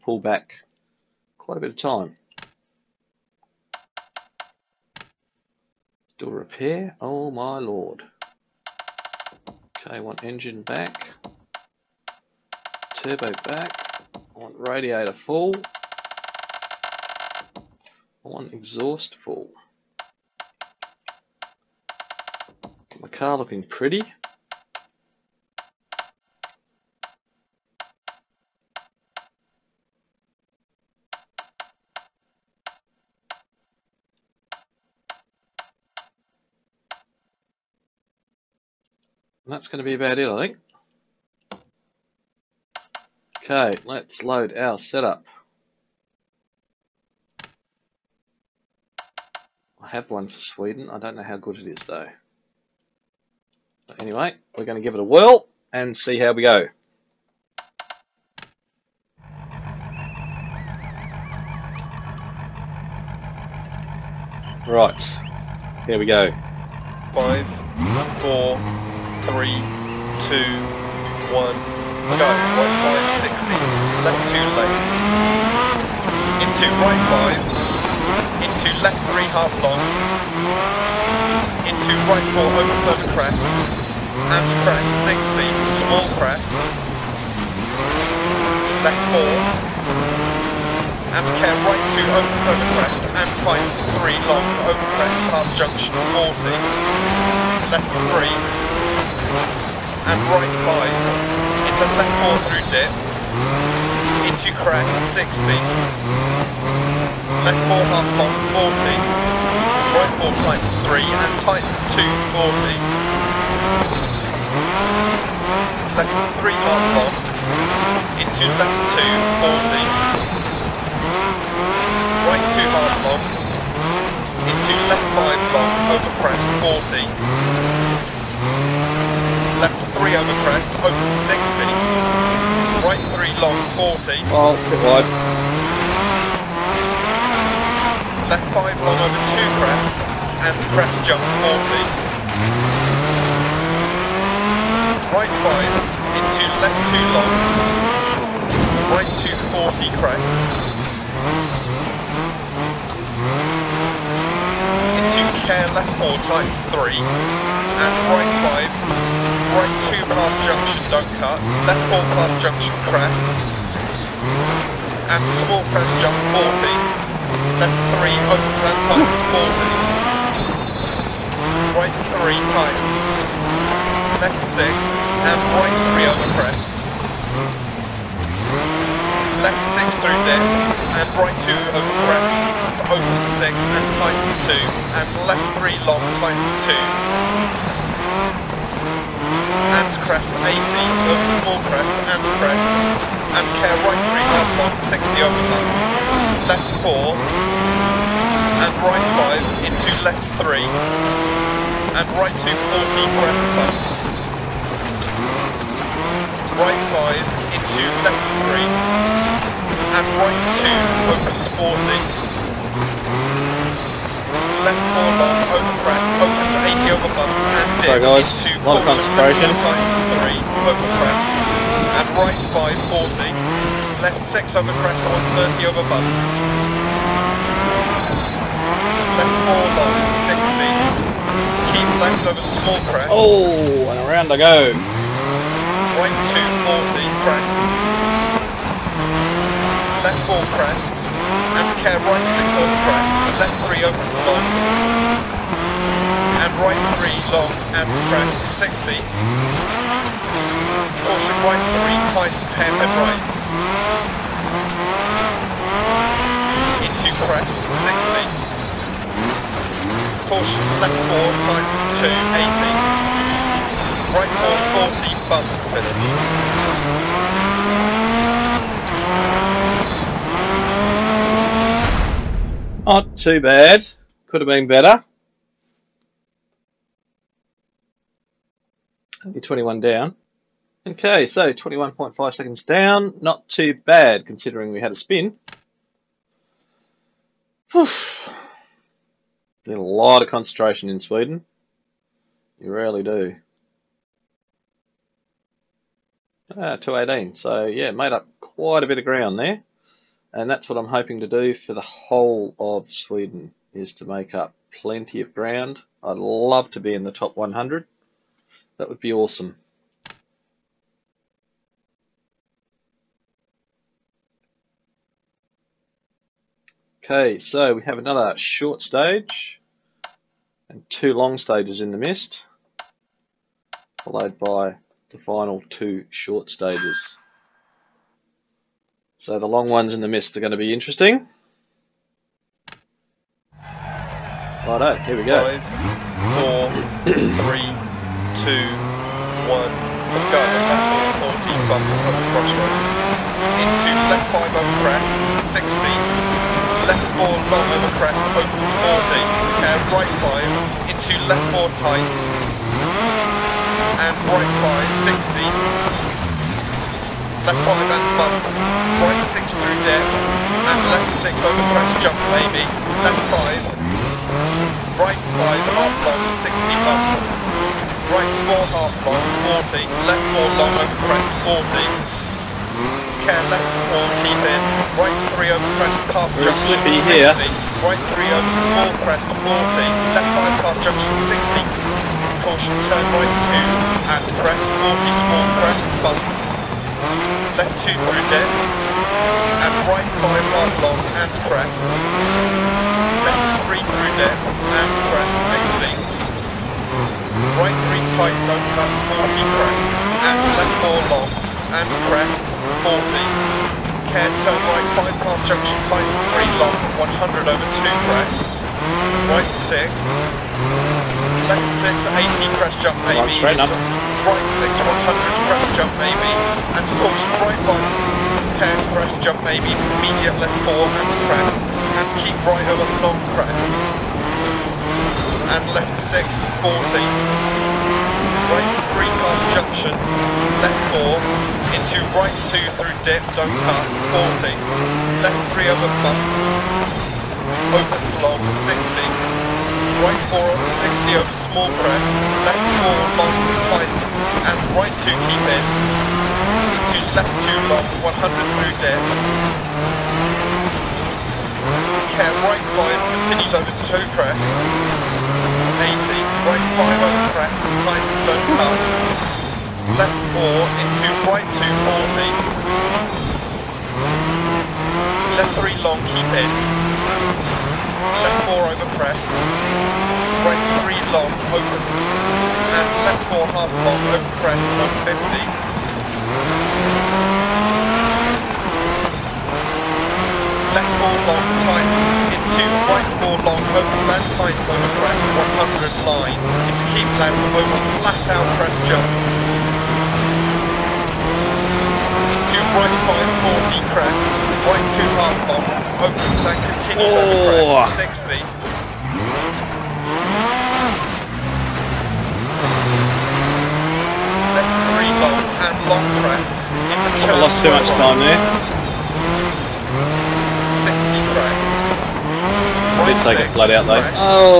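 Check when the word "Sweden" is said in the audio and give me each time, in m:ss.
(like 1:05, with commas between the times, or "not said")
0:50, 4:51, 5:02.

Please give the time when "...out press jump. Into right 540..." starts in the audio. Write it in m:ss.
8:08.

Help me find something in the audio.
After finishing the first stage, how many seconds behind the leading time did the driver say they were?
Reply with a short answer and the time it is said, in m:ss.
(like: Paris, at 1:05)
21.5, at 4:41.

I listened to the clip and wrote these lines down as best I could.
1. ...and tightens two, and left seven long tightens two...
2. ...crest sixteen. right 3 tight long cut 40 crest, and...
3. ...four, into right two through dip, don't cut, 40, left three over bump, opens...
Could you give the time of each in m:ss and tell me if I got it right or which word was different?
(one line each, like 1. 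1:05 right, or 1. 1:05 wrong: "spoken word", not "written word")
1. 3:03 wrong: "three", not "seven"
2. 6:35 right
3. 7:10 right.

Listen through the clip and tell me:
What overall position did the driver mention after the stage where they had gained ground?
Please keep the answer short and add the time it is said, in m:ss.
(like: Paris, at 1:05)
218, at 4:56.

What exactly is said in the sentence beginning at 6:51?
Left six, 18 press jump maybe.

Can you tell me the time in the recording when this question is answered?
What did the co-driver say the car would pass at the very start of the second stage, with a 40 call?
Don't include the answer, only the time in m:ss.
5:41.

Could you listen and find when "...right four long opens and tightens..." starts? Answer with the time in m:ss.
8:02.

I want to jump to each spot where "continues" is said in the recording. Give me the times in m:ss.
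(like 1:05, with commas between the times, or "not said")
7:33, 8:16.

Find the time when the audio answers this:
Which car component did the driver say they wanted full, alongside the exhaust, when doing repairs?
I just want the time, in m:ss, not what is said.
0:14.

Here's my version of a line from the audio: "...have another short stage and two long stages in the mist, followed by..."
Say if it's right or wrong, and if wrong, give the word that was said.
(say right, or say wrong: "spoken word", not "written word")
right.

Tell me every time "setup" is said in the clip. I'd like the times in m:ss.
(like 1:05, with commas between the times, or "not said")
0:44.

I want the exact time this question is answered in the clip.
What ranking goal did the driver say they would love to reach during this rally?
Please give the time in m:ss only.
5:07.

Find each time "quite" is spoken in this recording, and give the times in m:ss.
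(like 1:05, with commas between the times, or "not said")
0:01, 4:58.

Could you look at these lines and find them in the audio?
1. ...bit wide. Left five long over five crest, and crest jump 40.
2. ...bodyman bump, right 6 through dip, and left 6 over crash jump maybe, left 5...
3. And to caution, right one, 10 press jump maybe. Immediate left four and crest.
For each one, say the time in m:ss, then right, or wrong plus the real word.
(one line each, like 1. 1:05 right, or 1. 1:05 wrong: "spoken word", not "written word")
1. 2:14 wrong: "two", not "five"
2. 5:57 right
3. 6:56 right.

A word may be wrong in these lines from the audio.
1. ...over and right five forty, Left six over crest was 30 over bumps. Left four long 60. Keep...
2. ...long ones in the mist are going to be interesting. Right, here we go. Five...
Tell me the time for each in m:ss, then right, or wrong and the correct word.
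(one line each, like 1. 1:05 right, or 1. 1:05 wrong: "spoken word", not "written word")
1. 3:40 right
2. 5:29 right.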